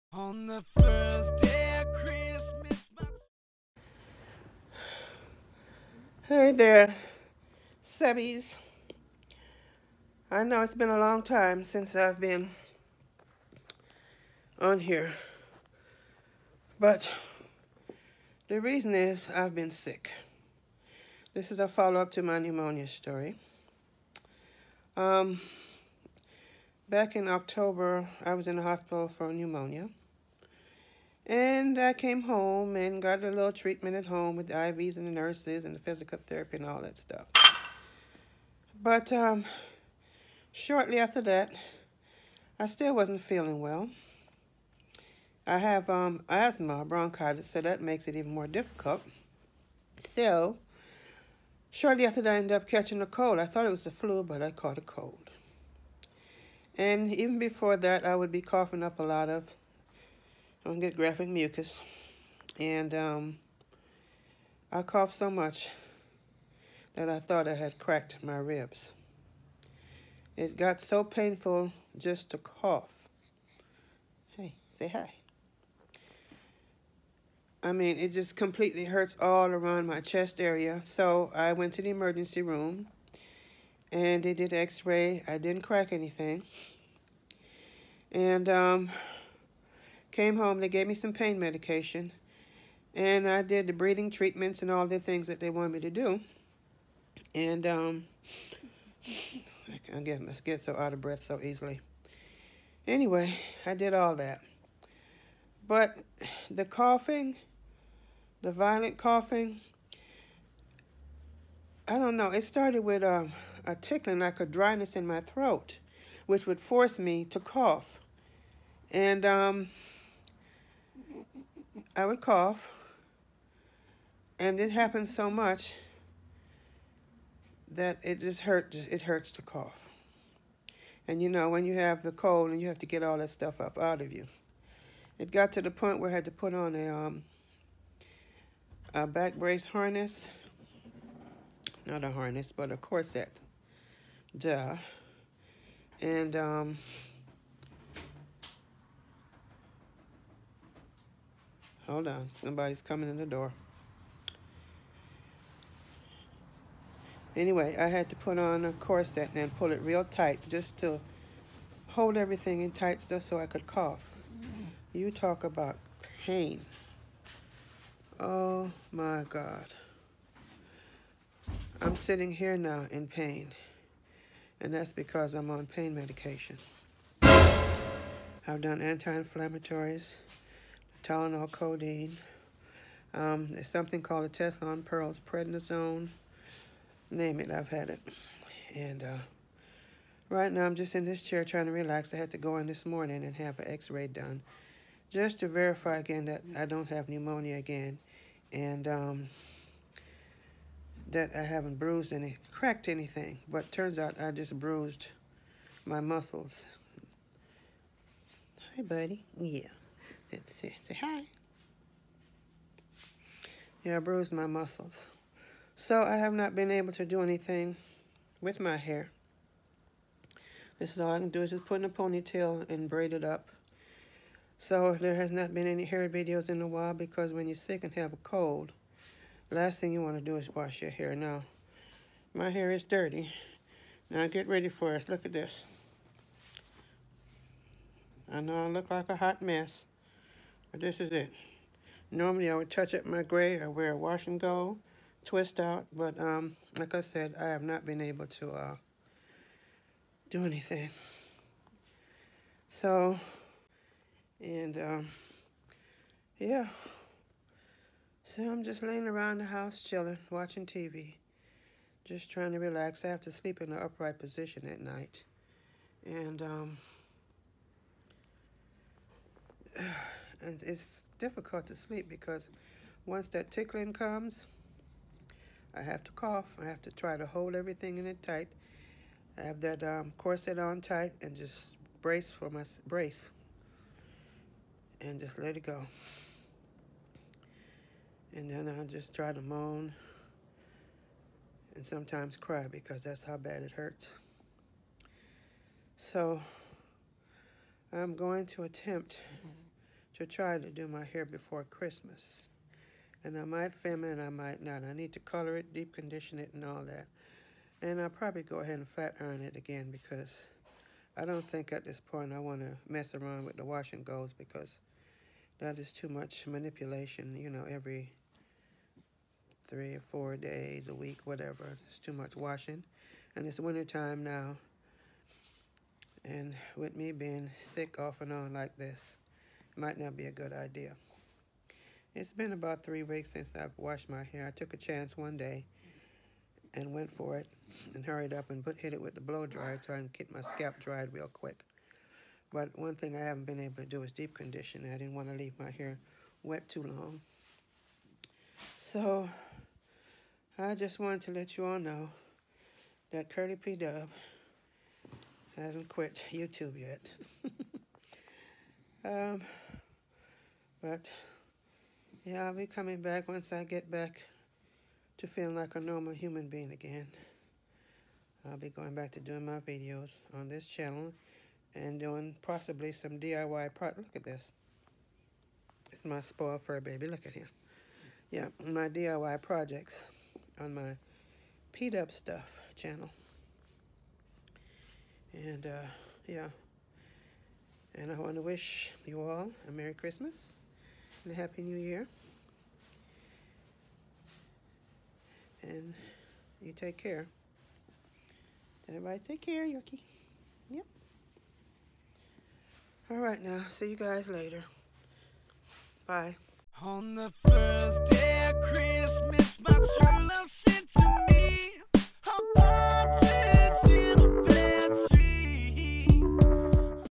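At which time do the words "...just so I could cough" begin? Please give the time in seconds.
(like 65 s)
163 s.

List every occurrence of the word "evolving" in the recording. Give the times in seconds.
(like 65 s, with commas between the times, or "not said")
not said.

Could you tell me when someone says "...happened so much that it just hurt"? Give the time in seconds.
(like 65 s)
124 s.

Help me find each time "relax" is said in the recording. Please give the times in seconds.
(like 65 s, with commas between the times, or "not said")
191 s, 262 s.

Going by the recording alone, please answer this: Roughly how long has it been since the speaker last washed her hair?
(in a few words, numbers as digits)
3 weeks.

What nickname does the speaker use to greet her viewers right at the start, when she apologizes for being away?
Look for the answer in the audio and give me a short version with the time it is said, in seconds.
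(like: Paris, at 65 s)
Sebbies, at 7 s.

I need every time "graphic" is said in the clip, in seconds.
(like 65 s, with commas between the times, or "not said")
60 s.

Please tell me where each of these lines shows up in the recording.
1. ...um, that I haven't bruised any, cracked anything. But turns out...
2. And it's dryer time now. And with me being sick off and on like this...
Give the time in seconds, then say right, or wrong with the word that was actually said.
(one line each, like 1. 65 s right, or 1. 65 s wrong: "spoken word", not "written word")
1. 198 s right
2. 323 s wrong: "winter", not "dryer".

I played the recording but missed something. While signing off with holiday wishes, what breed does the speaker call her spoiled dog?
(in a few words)
Yorkie.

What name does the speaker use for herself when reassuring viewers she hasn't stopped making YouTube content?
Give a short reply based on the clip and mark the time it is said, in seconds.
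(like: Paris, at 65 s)
Curly P. Dub, at 353 s.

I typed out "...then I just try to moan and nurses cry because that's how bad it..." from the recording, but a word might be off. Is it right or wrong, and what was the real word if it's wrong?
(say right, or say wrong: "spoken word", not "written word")
wrong: "sometimes", not "nurses".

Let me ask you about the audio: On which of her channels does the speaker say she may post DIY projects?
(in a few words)
P-Dub Stuff.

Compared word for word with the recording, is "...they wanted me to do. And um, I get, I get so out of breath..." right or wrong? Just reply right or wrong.
right.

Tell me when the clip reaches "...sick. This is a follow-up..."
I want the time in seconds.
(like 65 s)
19 s.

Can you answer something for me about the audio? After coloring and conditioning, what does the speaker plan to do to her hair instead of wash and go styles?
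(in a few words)
flat iron.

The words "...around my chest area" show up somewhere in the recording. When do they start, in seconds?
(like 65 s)
79 s.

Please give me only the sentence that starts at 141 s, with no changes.
Not a harness, but a corset.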